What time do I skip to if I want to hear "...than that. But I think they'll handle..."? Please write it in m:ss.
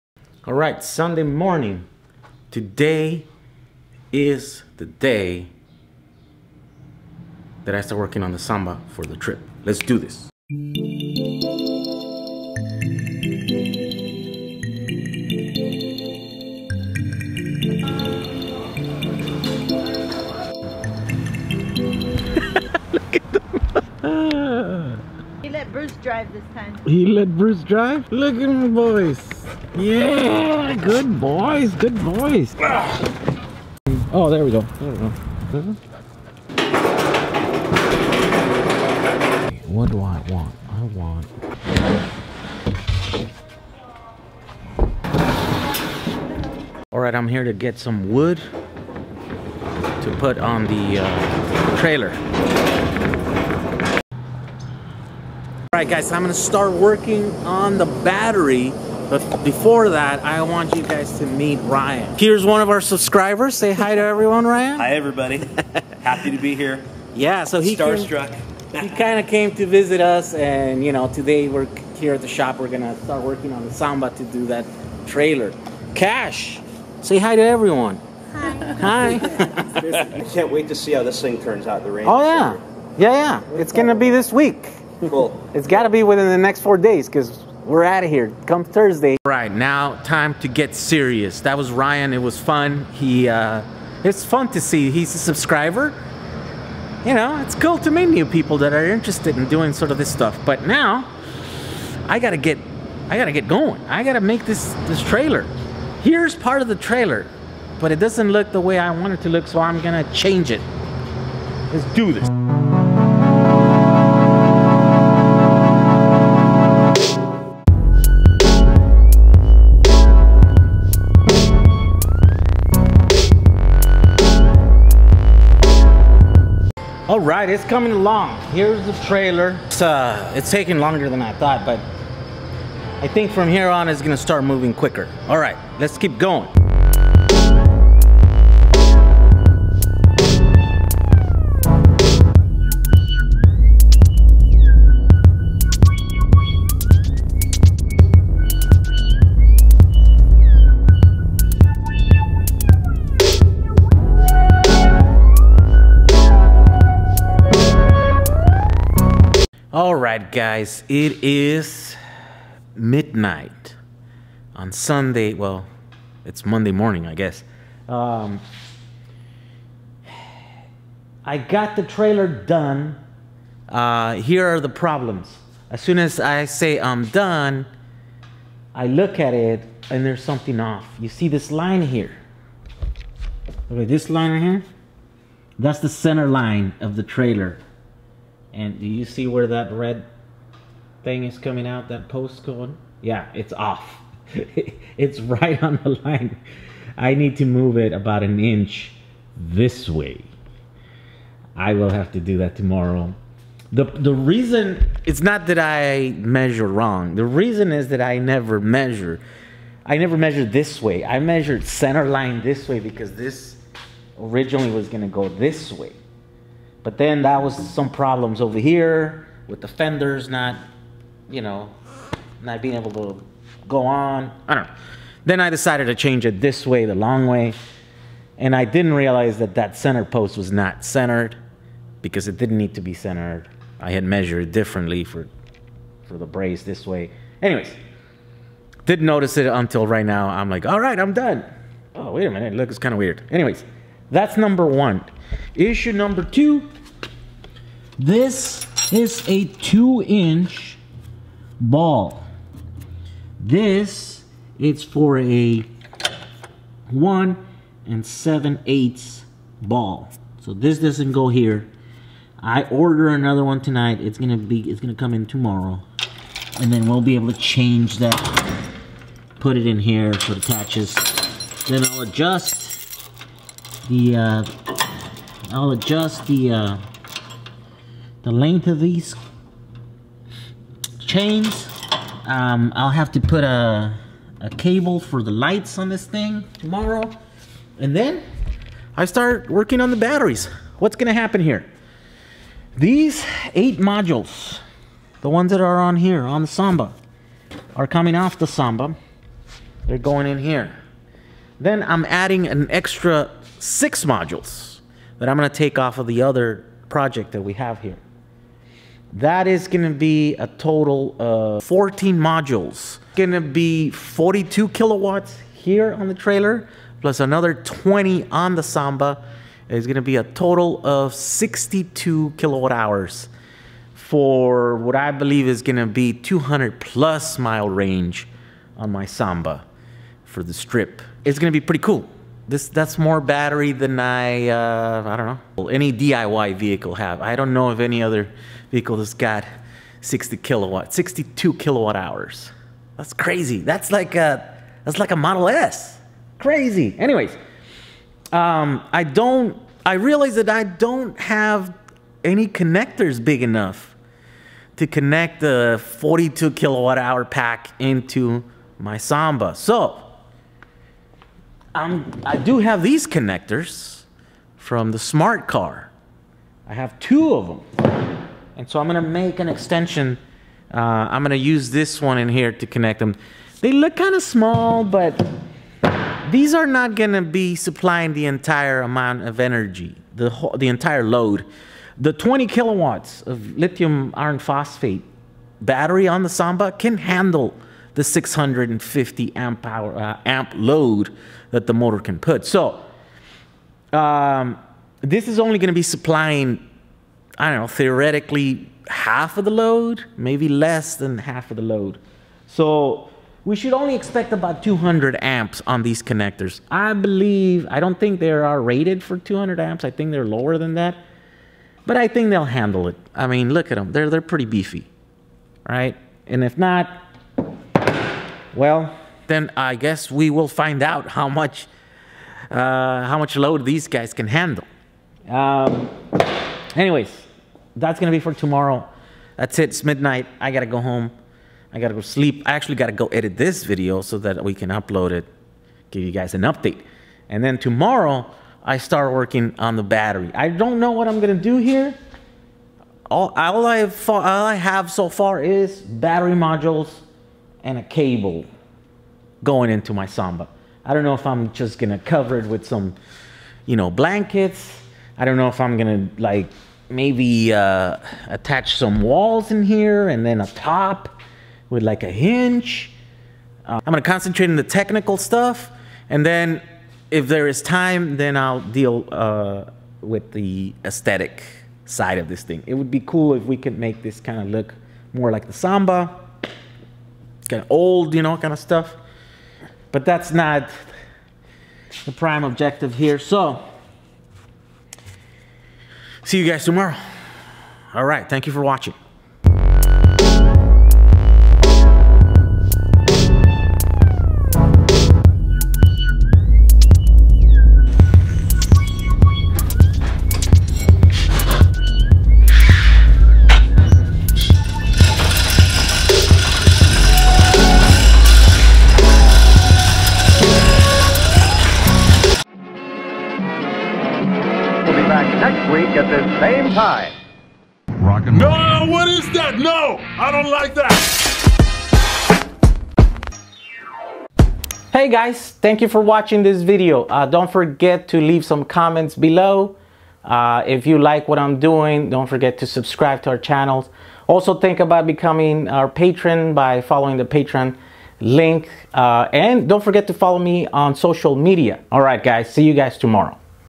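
6:50.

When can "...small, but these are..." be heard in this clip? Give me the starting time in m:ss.
6:14.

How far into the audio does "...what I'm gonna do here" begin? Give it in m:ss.
7:20.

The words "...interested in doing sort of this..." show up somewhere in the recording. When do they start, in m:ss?
1:38.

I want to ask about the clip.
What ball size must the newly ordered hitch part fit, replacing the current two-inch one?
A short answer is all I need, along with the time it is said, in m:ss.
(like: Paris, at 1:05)
1 7/8 inch, at 4:16.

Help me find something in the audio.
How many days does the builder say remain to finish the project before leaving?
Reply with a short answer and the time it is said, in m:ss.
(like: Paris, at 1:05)
4, at 1:26.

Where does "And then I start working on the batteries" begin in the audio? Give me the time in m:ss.
4:47.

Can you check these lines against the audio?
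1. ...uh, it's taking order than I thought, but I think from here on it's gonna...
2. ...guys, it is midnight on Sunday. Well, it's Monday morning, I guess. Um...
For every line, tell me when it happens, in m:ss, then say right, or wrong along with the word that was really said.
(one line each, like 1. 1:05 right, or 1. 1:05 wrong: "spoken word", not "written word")
1. 2:09 wrong: "longer", not "order"
2. 2:40 right.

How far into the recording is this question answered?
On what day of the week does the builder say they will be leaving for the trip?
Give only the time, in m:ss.
1:28.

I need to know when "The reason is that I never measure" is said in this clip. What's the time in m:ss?
3:27.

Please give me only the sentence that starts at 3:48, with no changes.
And I didn't realize that that center post was not centered because it didn't need to be centered.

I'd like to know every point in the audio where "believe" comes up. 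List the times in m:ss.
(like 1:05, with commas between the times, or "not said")
5:25, 6:46.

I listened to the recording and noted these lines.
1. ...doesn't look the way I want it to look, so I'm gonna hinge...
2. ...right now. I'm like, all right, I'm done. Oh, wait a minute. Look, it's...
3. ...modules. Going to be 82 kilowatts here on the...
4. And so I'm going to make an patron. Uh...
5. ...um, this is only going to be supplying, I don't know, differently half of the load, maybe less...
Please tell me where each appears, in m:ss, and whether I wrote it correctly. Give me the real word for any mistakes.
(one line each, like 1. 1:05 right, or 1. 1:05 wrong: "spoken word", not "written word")
1. 1:47 wrong: "change", not "hinge"
2. 3:59 right
3. 5:12 wrong: "42", not "82"
4. 6:08 wrong: "extension", not "patron"
5. 6:33 wrong: "theoretically", not "differently".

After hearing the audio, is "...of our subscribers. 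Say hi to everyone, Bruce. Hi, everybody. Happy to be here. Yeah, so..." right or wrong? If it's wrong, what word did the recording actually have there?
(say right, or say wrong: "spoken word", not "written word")
wrong: "Ryan", not "Bruce".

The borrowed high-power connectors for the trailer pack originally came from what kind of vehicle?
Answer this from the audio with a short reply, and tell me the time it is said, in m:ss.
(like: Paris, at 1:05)
Smart car, at 6:04.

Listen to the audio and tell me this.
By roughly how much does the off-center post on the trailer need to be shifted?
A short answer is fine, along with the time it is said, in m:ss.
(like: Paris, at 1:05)
About an inch, at 3:17.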